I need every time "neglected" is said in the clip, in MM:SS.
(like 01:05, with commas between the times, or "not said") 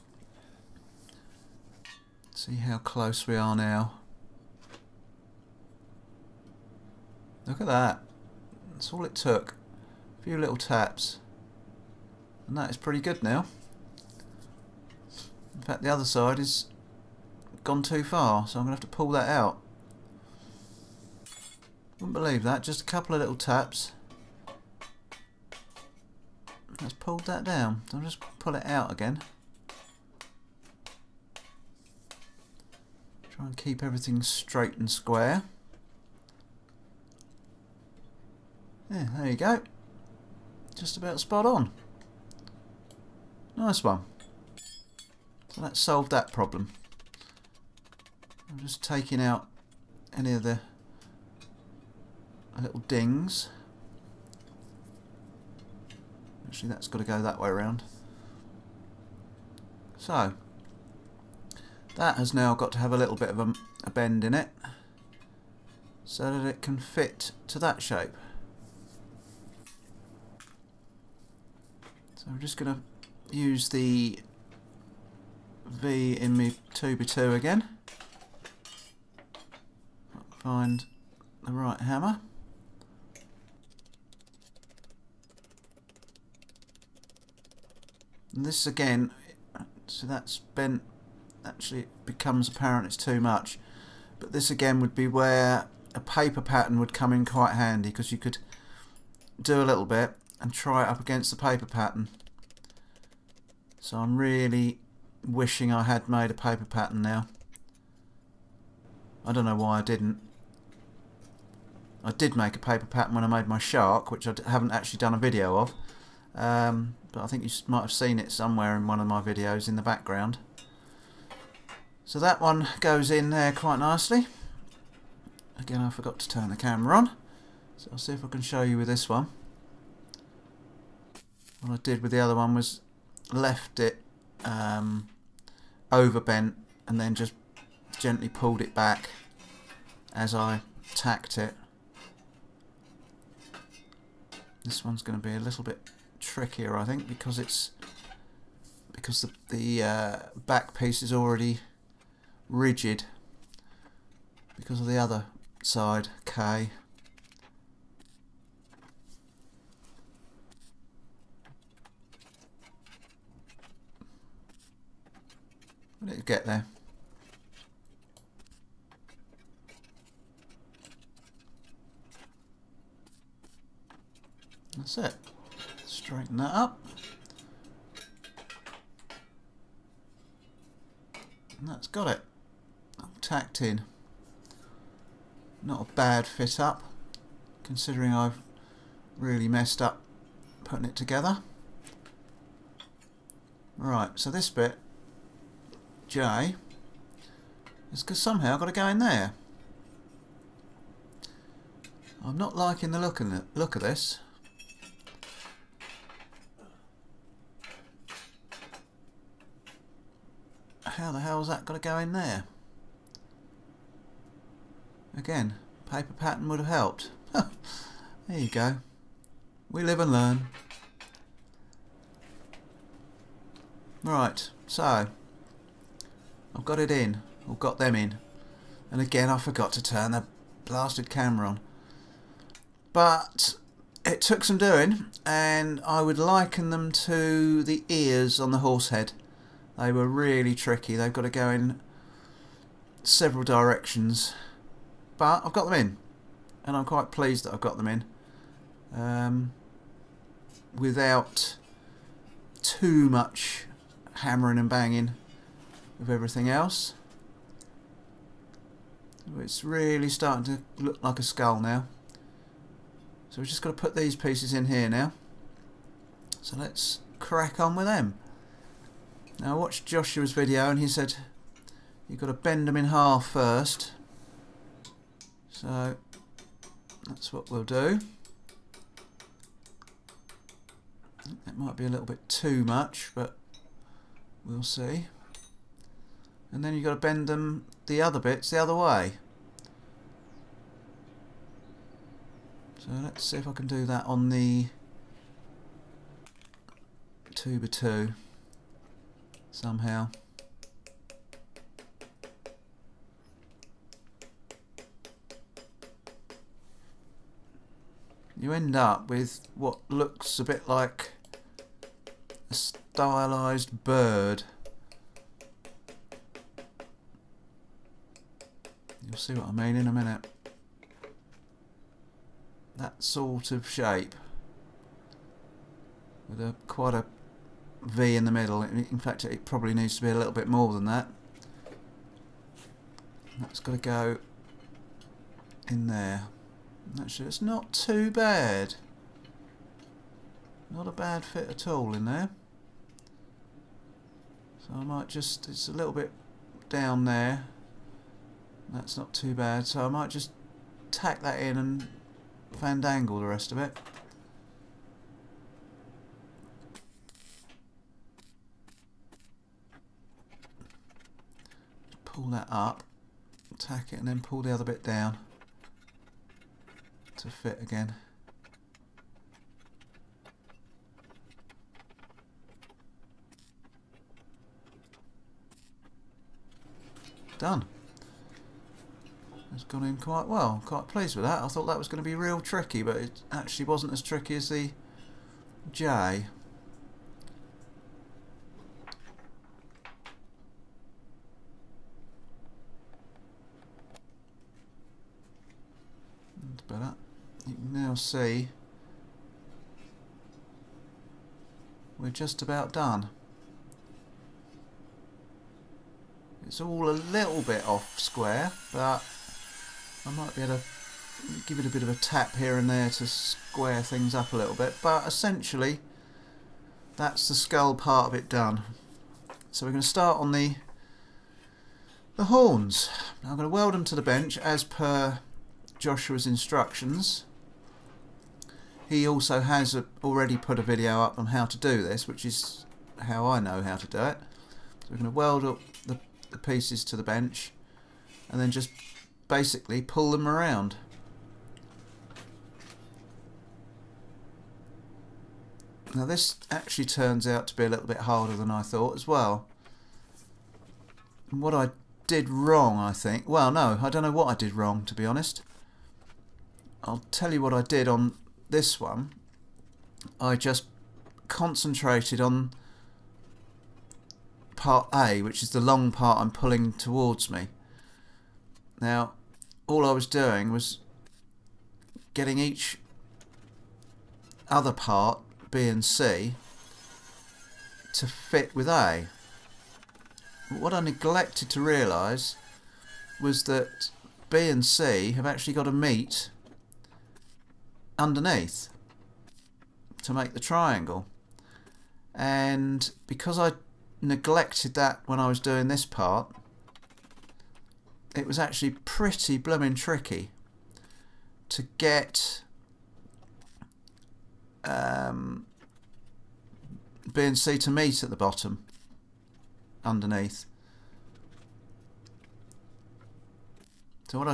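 08:00, 08:14.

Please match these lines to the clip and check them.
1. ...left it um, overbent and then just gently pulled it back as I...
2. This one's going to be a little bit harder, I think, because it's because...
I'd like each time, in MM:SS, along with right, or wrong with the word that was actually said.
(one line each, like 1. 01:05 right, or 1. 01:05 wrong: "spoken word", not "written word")
1. 02:13 right
2. 02:24 wrong: "trickier", not "harder".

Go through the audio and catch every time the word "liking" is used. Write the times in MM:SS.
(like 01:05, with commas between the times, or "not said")
03:22.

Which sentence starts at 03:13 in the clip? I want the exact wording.
Right, so this bit, J, is because somehow I've got to go in there.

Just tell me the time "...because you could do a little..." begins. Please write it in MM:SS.
01:37.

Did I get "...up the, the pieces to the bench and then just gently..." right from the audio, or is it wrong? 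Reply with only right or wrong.
wrong.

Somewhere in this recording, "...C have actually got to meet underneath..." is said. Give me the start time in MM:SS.
08:04.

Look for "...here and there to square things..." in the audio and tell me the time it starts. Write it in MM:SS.
06:52.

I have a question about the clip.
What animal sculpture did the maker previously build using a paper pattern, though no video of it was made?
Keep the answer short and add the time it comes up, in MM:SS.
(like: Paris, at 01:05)
Shark, at 01:53.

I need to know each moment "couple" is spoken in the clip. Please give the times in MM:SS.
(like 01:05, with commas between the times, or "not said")
00:22.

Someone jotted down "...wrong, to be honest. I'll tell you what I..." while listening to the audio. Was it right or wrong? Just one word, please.
right.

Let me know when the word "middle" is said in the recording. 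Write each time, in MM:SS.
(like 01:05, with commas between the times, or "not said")
05:28.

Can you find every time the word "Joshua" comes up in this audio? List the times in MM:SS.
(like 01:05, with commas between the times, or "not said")
04:29, 07:05.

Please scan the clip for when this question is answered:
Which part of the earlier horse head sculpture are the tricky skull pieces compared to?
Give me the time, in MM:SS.
03:57.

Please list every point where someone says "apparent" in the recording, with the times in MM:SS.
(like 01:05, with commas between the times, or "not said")
01:32.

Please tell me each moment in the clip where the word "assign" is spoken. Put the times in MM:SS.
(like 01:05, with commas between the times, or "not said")
not said.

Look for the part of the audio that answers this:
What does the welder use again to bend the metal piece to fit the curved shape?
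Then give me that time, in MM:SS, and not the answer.
01:13.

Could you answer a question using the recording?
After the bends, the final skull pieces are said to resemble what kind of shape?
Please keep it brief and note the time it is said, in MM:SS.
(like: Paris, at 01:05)
A stylized bird, at 05:12.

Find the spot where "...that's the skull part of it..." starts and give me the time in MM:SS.
06:56.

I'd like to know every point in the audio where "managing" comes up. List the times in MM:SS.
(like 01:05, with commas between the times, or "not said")
not said.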